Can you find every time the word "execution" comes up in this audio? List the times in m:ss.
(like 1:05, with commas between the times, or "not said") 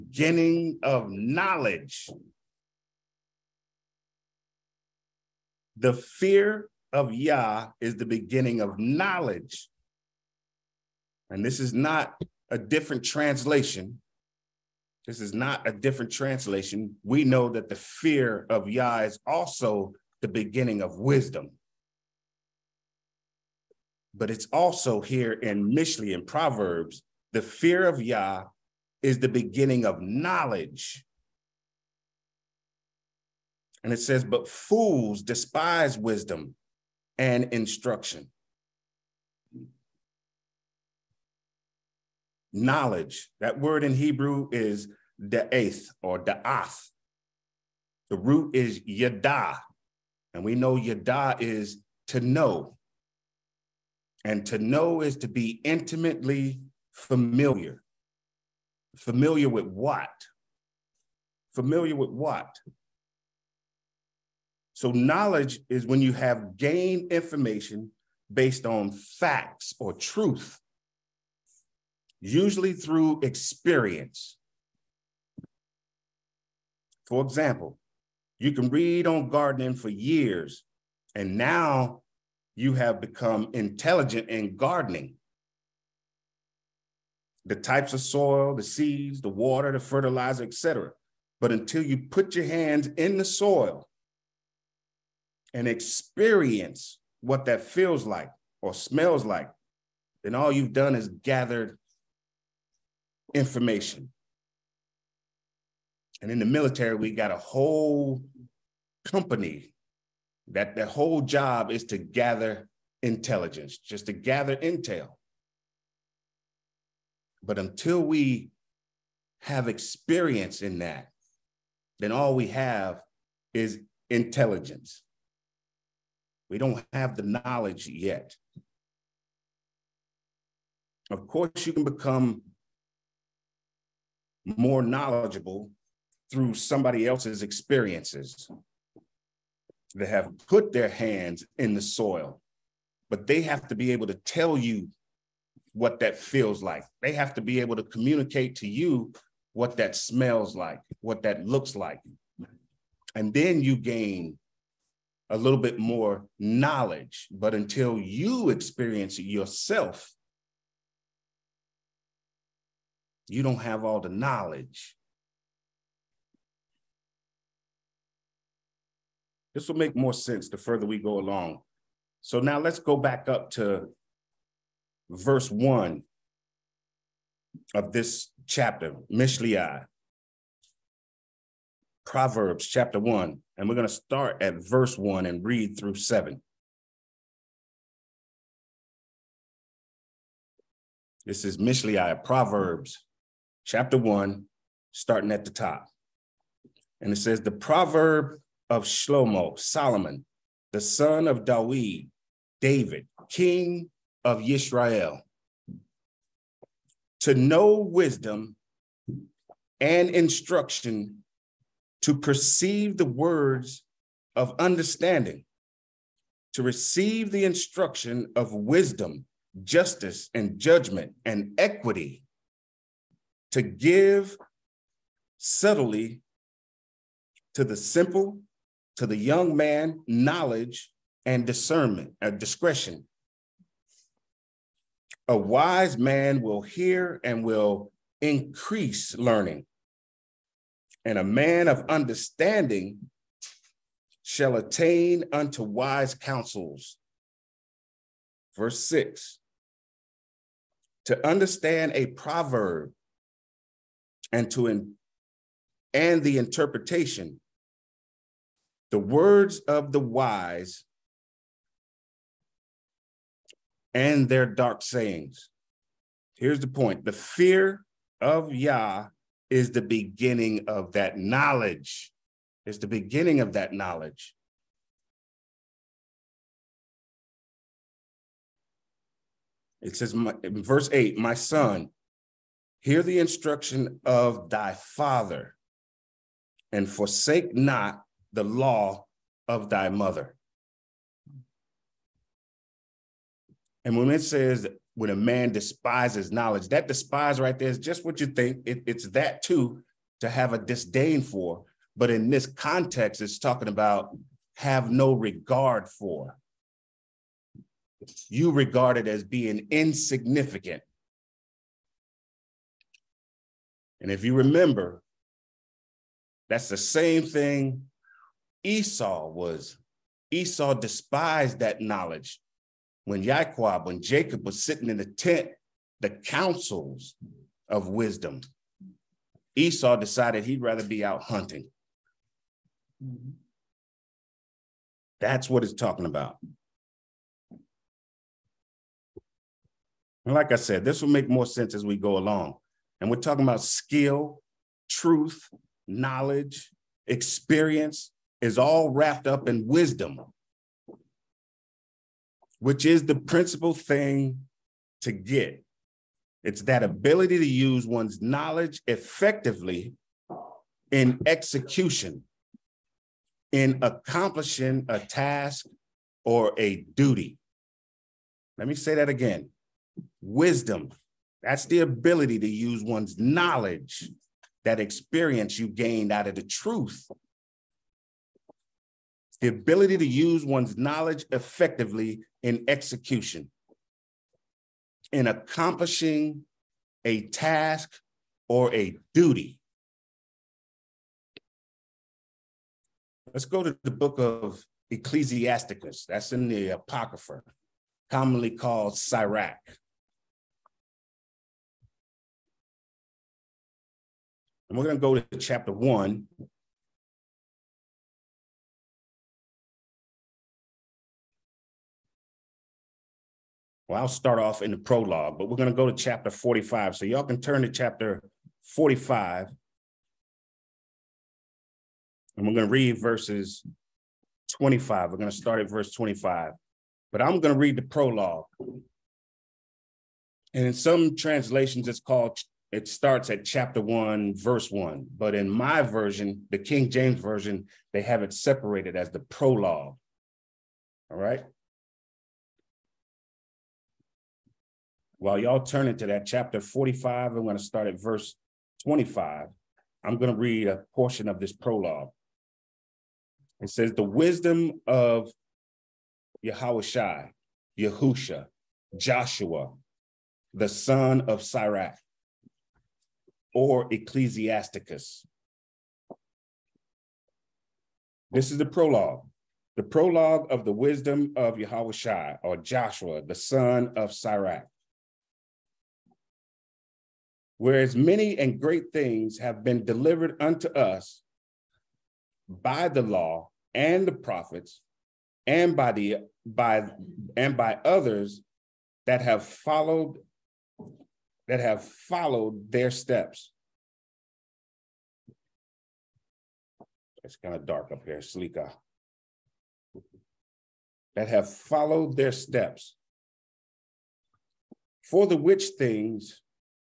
6:01, 6:22.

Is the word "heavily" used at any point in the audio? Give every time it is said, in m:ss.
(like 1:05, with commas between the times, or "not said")
not said.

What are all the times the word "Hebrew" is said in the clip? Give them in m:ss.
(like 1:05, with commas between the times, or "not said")
0:43.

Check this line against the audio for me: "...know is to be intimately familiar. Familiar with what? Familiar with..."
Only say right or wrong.
right.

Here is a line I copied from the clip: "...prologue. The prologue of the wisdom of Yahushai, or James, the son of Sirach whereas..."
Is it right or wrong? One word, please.
wrong.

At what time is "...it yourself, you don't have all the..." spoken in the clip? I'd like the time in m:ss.
2:39.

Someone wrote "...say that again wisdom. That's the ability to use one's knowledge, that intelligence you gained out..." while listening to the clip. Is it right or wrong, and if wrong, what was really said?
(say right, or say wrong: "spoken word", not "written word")
wrong: "experience", not "intelligence".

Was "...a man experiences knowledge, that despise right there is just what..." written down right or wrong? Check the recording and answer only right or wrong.
wrong.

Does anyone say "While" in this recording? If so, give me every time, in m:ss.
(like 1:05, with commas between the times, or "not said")
7:25.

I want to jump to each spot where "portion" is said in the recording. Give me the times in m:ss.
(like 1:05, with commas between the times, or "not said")
7:30.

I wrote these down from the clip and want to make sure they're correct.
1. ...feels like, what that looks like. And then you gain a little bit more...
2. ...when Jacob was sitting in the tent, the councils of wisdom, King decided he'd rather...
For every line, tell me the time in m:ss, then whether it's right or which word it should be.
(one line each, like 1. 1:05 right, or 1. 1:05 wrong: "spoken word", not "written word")
1. 2:29 wrong: "smells", not "feels"
2. 5:23 wrong: "Esau", not "King".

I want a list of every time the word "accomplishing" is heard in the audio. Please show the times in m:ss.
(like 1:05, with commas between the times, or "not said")
6:03, 6:25.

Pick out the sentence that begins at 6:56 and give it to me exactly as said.
So y'all can turn to chapter 45.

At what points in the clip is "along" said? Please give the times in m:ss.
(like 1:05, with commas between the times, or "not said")
2:51, 5:42.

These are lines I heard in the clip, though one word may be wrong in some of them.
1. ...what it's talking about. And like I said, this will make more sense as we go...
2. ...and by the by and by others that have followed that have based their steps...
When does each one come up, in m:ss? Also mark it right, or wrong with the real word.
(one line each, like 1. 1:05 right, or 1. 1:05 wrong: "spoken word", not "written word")
1. 5:35 right
2. 8:05 wrong: "followed", not "based".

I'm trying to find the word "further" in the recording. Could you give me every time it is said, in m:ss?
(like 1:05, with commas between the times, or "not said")
2:50.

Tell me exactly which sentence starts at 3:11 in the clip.
This is Mishlei, Proverbs chapter 1, starting at the top.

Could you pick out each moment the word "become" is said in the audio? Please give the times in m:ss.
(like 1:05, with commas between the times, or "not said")
1:22, 2:11.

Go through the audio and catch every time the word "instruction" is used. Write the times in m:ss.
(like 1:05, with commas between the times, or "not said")
0:37, 3:30, 3:37, 4:43.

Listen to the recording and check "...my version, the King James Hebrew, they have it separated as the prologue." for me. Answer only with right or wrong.
wrong.